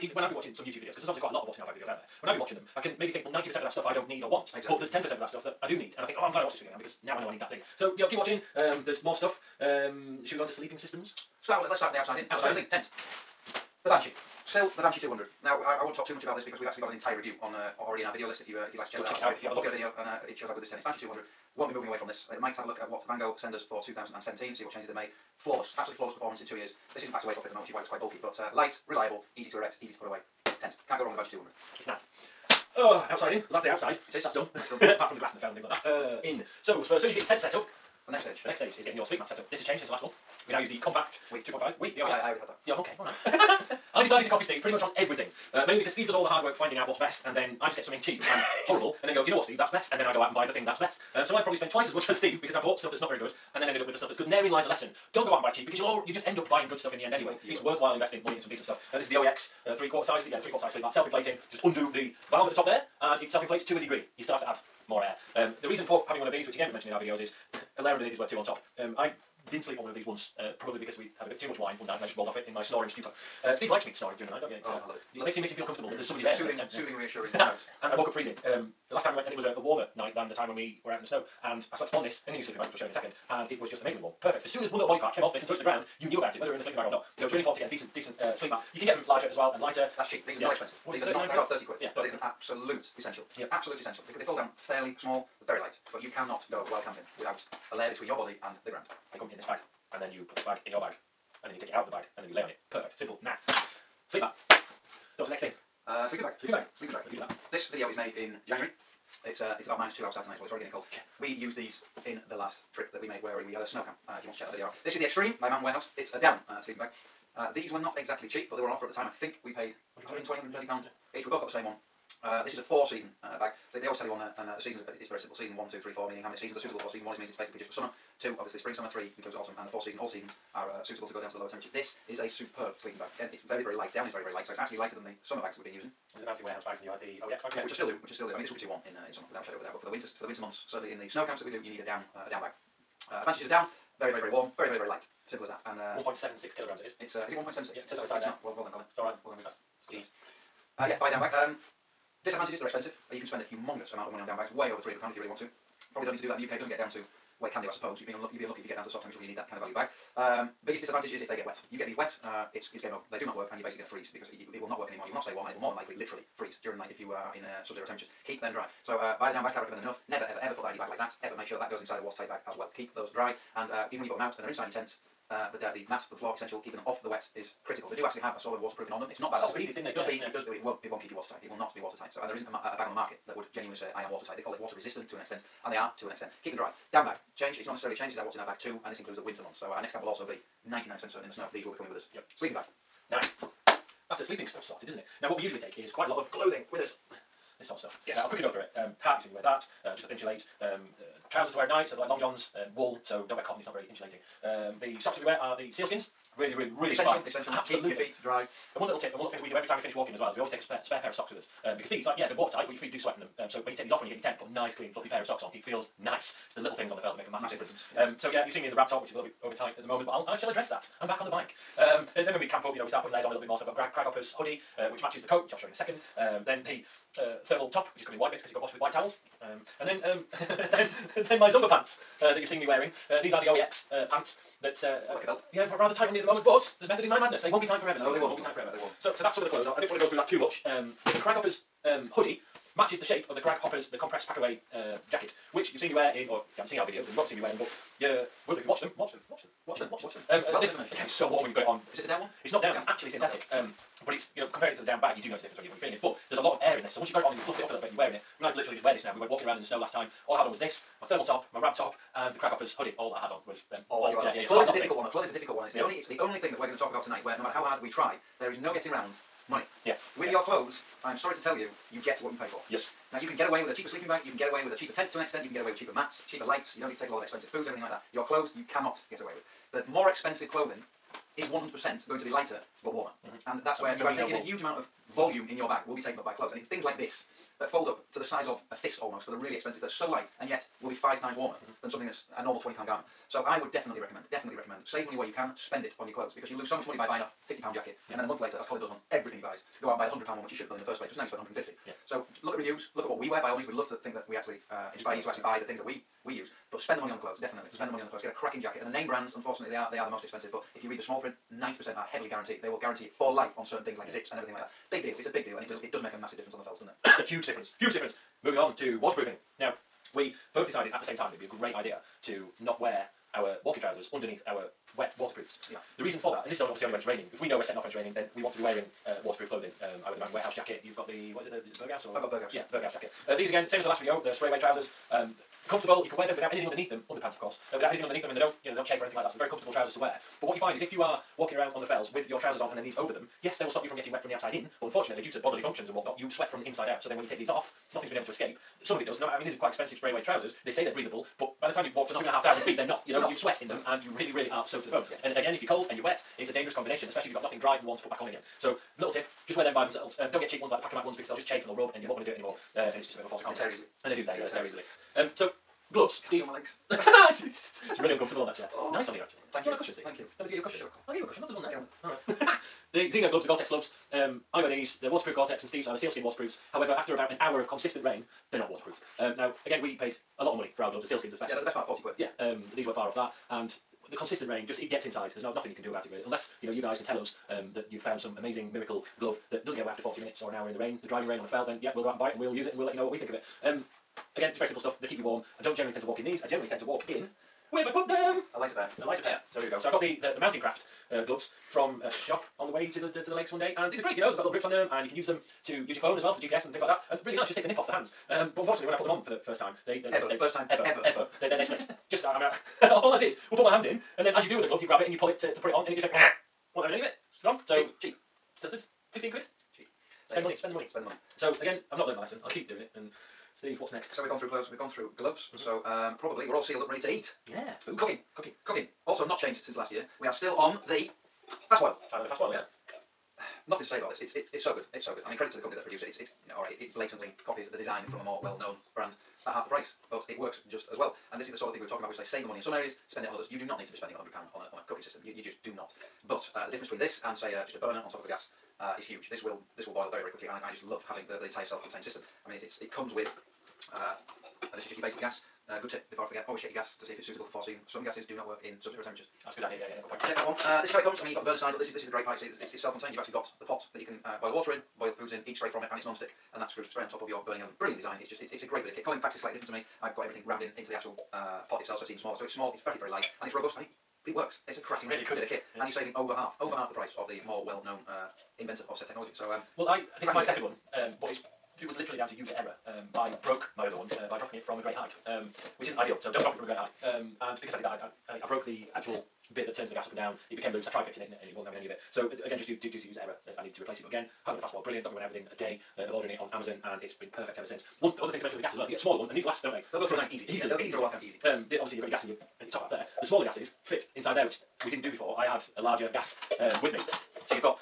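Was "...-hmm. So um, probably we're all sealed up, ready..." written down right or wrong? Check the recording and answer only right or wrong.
right.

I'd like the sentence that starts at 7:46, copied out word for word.
And that screws straight on top of your burning element.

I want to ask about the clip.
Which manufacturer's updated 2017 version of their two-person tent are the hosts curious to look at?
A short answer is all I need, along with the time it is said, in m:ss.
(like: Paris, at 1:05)
Vango, at 0:23.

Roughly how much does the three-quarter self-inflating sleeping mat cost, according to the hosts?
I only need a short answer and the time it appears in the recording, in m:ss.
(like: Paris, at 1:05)
£30, at 1:31.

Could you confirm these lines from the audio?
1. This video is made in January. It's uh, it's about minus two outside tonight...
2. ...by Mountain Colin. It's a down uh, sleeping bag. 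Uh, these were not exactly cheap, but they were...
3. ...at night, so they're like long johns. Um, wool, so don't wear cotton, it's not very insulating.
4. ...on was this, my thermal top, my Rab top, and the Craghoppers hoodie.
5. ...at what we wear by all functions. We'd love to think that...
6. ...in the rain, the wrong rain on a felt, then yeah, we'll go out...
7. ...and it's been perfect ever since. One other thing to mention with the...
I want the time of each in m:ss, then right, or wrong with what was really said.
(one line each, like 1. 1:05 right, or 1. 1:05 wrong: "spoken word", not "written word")
1. 1:47 right
2. 1:55 wrong: "Warehouse", not "Colin"
3. 3:21 right
4. 4:20 right
5. 5:03 wrong: "means", not "functions"
6. 6:30 wrong: "driving", not "wrong"
7. 8:16 right.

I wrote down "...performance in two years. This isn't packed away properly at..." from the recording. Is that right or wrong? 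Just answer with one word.
right.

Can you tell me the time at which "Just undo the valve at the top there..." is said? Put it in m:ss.
1:01.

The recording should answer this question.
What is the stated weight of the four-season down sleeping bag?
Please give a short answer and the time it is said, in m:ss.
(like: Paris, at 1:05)
1.76 kilograms, at 2:26.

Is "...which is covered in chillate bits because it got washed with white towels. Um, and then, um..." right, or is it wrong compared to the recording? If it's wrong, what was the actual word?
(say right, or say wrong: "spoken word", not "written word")
wrong: "white", not "chillate".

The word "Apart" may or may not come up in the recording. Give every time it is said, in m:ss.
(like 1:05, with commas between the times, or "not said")
0:34.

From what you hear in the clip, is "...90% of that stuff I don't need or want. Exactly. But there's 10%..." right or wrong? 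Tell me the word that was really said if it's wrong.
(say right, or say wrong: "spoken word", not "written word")
right.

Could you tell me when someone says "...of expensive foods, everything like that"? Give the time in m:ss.
4:37.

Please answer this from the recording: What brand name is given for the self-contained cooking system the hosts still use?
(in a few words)
Highlander.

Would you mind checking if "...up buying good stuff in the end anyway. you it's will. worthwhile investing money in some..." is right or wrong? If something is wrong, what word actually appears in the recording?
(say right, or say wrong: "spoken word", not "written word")
right.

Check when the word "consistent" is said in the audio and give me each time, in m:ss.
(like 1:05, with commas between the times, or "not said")
6:17, 6:24.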